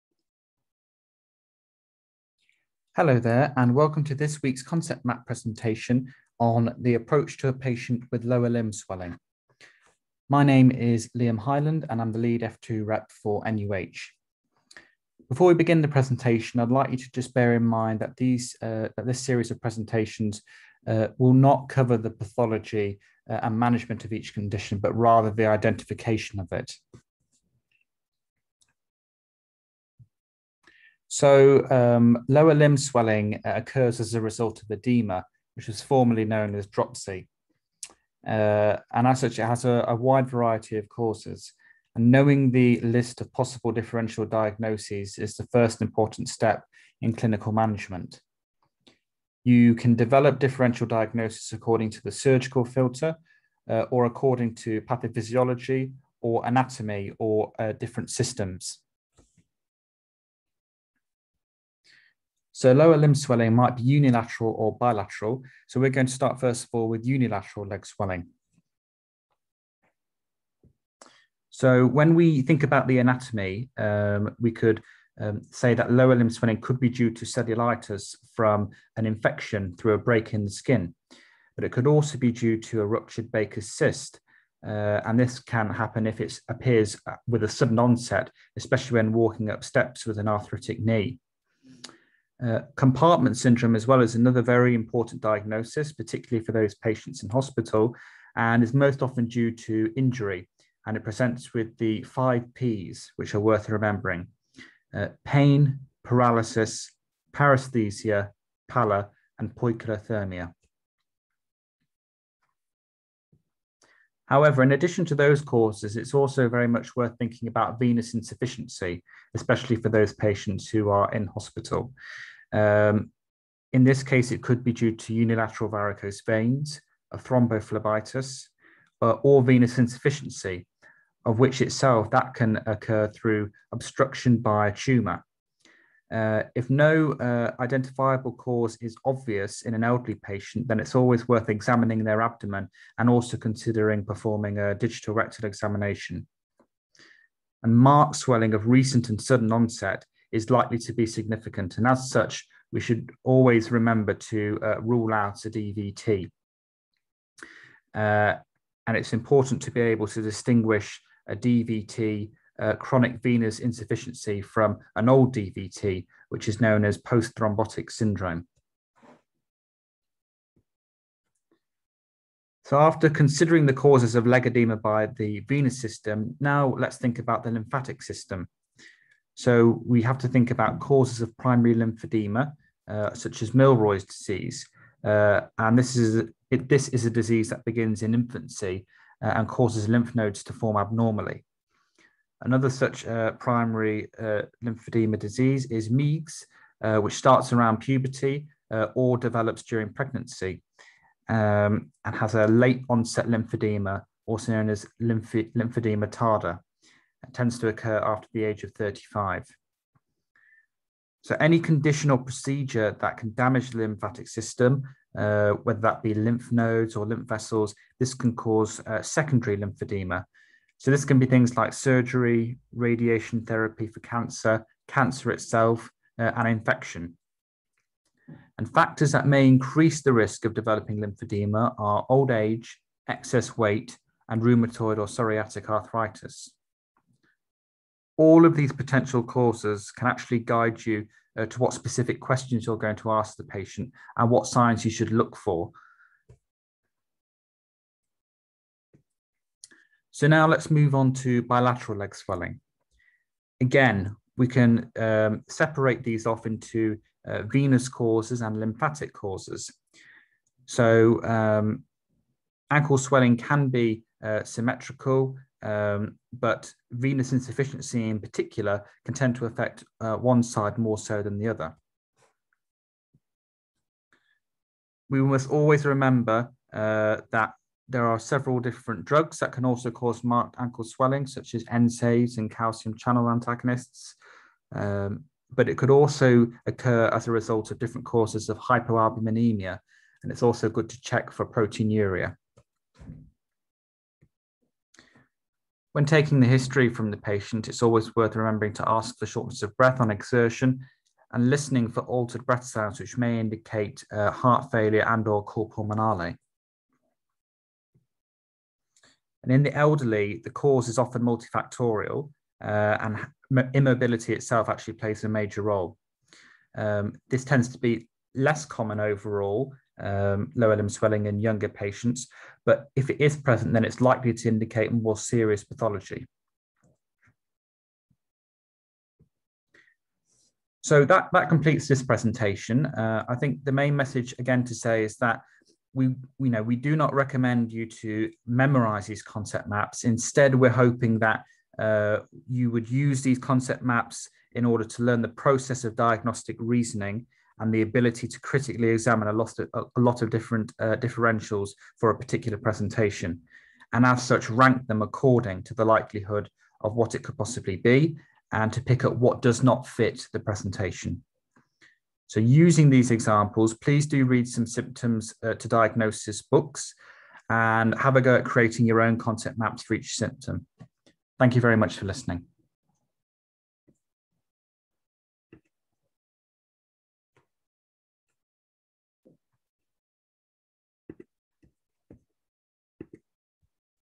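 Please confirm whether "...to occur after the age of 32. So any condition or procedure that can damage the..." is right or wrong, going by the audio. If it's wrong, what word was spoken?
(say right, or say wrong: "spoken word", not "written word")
wrong: "35", not "32".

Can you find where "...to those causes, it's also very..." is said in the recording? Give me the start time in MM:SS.
01:55.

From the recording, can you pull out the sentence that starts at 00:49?
You can develop differential diagnosis according to the surgical filter uh, or according to pathophysiology or anatomy or uh, different systems.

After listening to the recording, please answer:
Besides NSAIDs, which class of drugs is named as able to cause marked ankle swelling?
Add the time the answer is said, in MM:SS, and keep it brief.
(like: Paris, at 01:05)
calcium channel antagonists, at 04:42.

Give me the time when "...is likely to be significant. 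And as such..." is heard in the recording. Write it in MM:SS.
02:30.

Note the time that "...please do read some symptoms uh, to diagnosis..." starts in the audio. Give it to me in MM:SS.
06:03.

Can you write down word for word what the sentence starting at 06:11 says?
Thank you very much for listening.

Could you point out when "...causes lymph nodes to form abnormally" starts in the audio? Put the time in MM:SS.
03:09.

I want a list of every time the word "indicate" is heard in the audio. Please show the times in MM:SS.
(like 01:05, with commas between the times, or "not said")
05:03, 05:24.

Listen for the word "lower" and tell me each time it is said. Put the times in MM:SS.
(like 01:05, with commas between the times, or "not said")
00:08, 00:32, 01:02, 01:15, 05:20.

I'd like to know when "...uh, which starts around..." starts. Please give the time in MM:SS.
03:16.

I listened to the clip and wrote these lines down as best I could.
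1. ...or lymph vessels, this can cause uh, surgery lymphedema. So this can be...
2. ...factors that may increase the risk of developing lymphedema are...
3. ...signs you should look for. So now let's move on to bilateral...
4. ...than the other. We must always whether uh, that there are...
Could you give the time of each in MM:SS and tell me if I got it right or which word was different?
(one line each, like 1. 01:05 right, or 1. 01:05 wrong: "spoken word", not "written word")
1. 03:36 wrong: "secondary", not "surgery"
2. 03:48 right
3. 04:04 right
4. 04:31 wrong: "remember", not "whether".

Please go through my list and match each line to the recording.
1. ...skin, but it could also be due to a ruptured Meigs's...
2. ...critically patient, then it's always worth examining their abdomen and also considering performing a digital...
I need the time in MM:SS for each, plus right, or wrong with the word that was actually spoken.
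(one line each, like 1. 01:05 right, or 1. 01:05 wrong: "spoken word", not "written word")
1. 01:20 wrong: "Baker", not "Meigs"
2. 02:19 wrong: "elderly", not "critically".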